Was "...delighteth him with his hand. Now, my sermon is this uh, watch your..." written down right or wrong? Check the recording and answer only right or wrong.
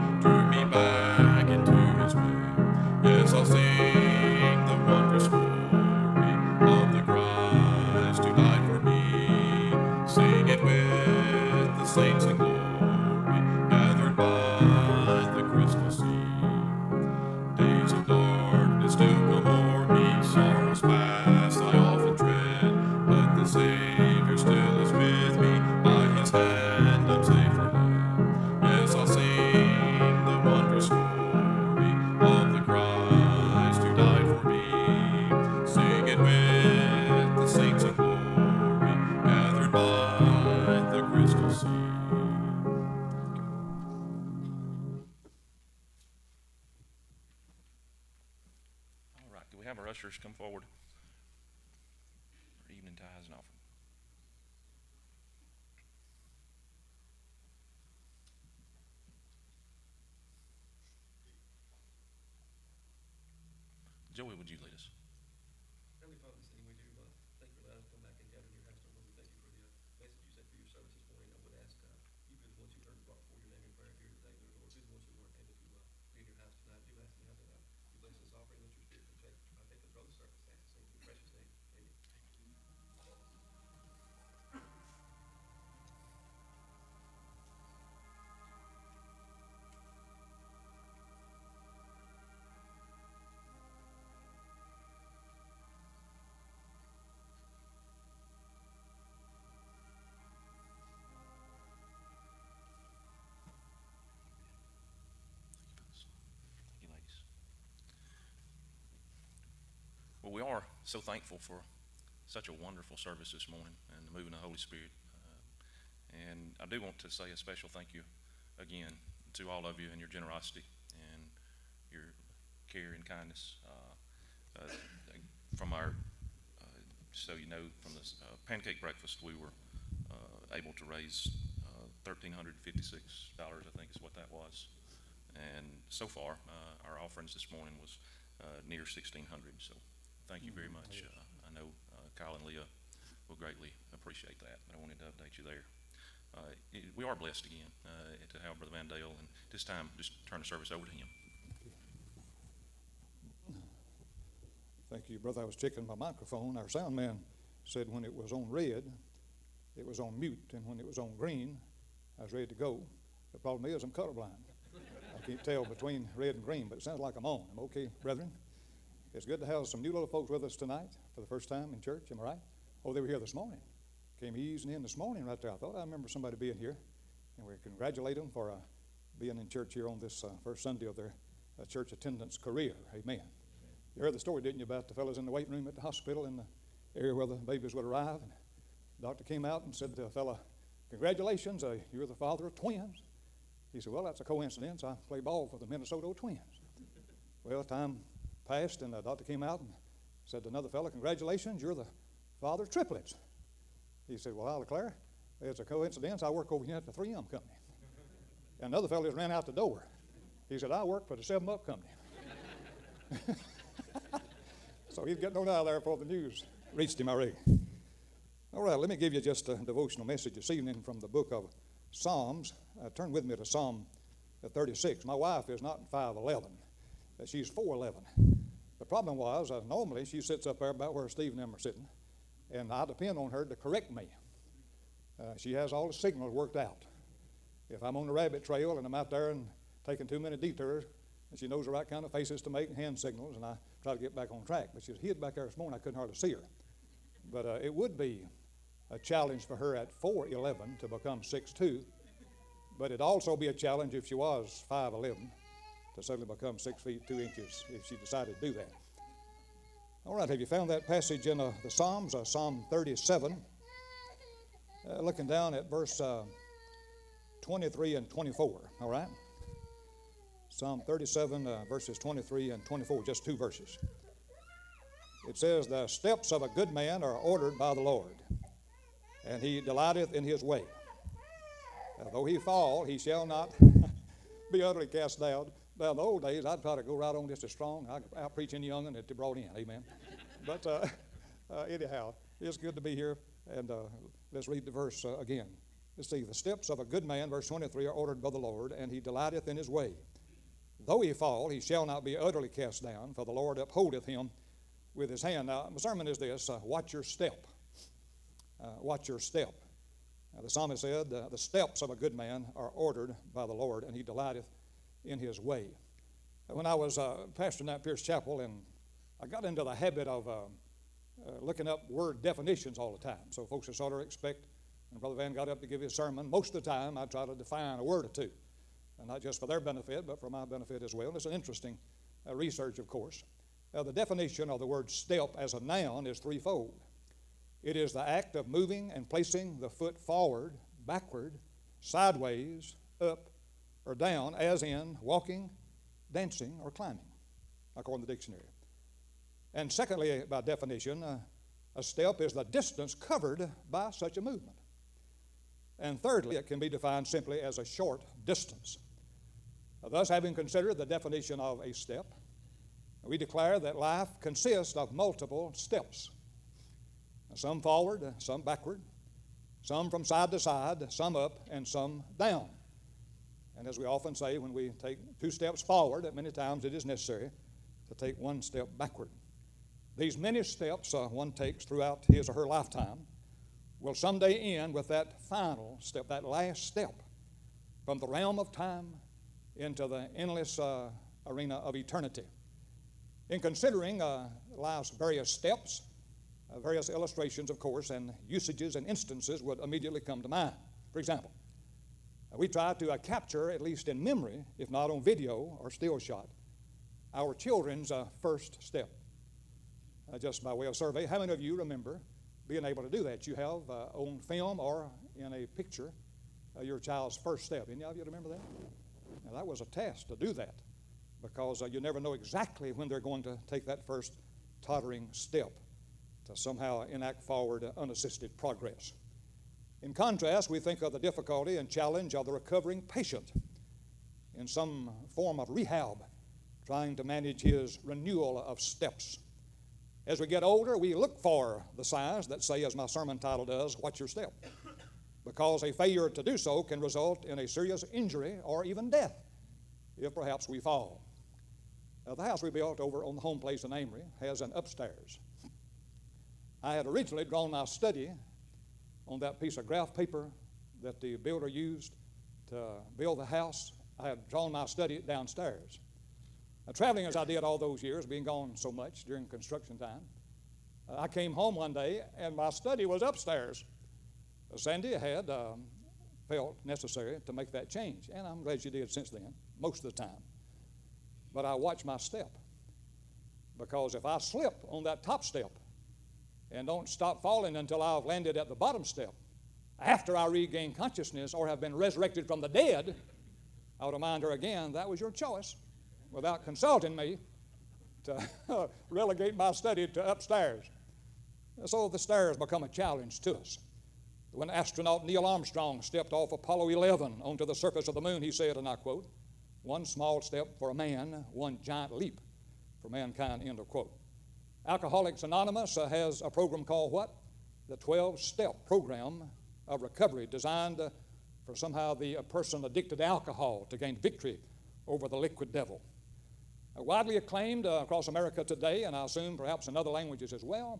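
wrong.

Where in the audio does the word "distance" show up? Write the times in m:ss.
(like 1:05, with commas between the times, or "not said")
5:52, 5:58.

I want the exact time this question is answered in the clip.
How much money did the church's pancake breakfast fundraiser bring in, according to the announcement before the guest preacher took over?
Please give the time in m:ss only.
2:12.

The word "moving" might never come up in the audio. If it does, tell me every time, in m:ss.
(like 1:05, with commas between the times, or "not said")
1:54, 5:38.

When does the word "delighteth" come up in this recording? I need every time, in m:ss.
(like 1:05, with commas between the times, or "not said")
4:39, 4:58, 5:14.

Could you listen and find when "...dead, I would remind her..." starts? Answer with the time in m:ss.
8:12.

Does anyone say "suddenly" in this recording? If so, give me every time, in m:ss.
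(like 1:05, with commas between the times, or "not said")
4:16.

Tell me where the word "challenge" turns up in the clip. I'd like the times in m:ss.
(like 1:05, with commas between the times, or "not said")
4:09, 4:13, 7:11, 8:22.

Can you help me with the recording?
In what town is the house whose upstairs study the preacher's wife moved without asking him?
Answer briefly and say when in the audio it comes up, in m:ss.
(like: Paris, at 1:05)
Amory, at 7:33.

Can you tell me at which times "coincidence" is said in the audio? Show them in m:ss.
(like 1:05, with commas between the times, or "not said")
3:14, 3:25.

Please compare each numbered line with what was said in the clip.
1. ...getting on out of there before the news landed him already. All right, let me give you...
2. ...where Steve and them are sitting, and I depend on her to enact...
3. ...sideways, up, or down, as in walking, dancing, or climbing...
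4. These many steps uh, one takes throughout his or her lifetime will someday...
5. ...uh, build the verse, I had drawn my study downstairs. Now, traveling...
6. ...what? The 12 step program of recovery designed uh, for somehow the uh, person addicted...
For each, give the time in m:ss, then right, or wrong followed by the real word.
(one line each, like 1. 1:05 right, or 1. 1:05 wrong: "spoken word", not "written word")
1. 3:35 wrong: "reached", not "landed"
2. 3:50 wrong: "correct", not "enact"
3. 5:41 right
4. 6:19 right
5. 7:42 wrong: "house", not "verse"
6. 8:36 right.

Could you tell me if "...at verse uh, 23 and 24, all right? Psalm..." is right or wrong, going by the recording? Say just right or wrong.
right.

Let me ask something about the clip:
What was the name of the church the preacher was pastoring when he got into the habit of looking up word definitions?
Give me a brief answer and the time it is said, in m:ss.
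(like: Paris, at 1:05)
Pierce Chapel, at 5:17.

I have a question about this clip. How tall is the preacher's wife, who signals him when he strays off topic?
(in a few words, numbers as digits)
4'11.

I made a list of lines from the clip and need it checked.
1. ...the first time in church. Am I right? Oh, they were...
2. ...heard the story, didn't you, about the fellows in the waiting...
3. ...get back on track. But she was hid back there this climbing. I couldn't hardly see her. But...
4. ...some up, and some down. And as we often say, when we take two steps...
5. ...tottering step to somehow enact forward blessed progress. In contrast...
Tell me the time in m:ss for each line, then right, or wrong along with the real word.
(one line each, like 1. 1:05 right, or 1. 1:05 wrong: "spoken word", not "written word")
1. 2:51 right
2. 3:04 right
3. 4:03 wrong: "morning", not "climbing"
4. 6:10 right
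5. 7:04 wrong: "unassisted", not "blessed".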